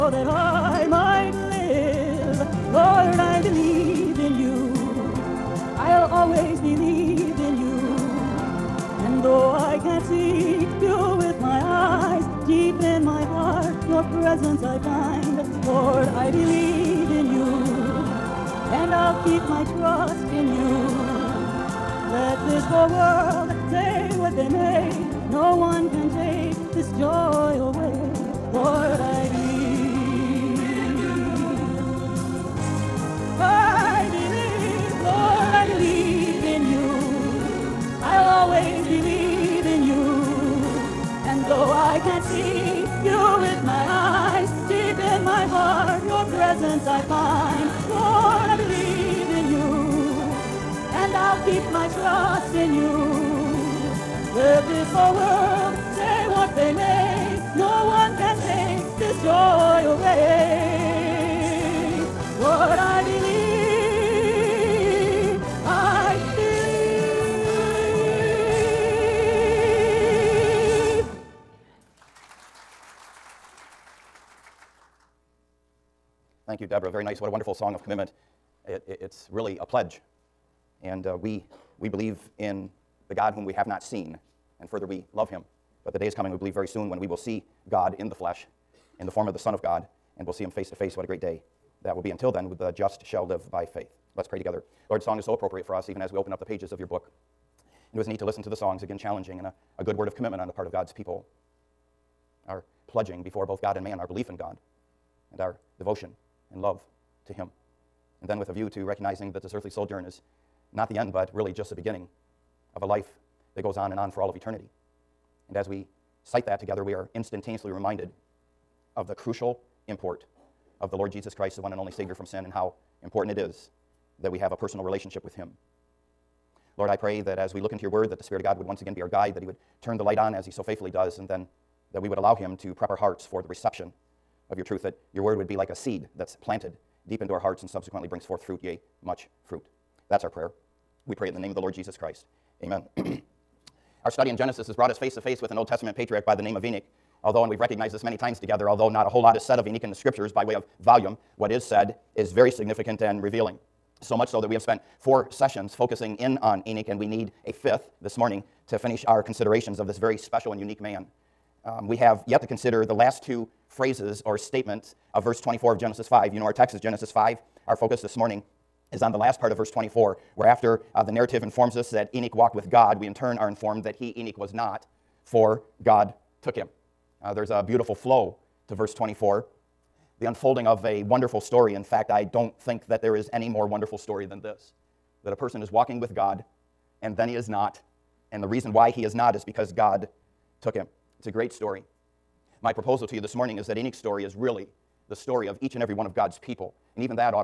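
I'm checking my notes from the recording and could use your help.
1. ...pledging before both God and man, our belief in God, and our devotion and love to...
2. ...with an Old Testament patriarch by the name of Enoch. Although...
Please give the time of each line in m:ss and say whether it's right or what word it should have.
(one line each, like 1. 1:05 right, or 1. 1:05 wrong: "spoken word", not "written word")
1. 1:42 right
2. 2:25 right.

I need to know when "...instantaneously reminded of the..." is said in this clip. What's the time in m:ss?
1:57.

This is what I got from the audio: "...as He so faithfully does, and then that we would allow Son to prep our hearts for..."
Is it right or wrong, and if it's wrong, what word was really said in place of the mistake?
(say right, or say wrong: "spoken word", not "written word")
wrong: "Him", not "Son".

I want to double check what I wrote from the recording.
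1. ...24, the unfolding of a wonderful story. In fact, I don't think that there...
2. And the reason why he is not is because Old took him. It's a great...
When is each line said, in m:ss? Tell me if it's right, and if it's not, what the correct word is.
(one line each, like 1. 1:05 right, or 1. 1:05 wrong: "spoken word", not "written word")
1. 2:58 right
2. 3:08 wrong: "God", not "Old".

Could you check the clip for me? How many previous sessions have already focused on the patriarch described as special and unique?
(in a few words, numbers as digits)
4.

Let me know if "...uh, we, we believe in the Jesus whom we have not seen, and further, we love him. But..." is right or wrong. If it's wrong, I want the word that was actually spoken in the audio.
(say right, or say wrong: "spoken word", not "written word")
wrong: "God", not "Jesus".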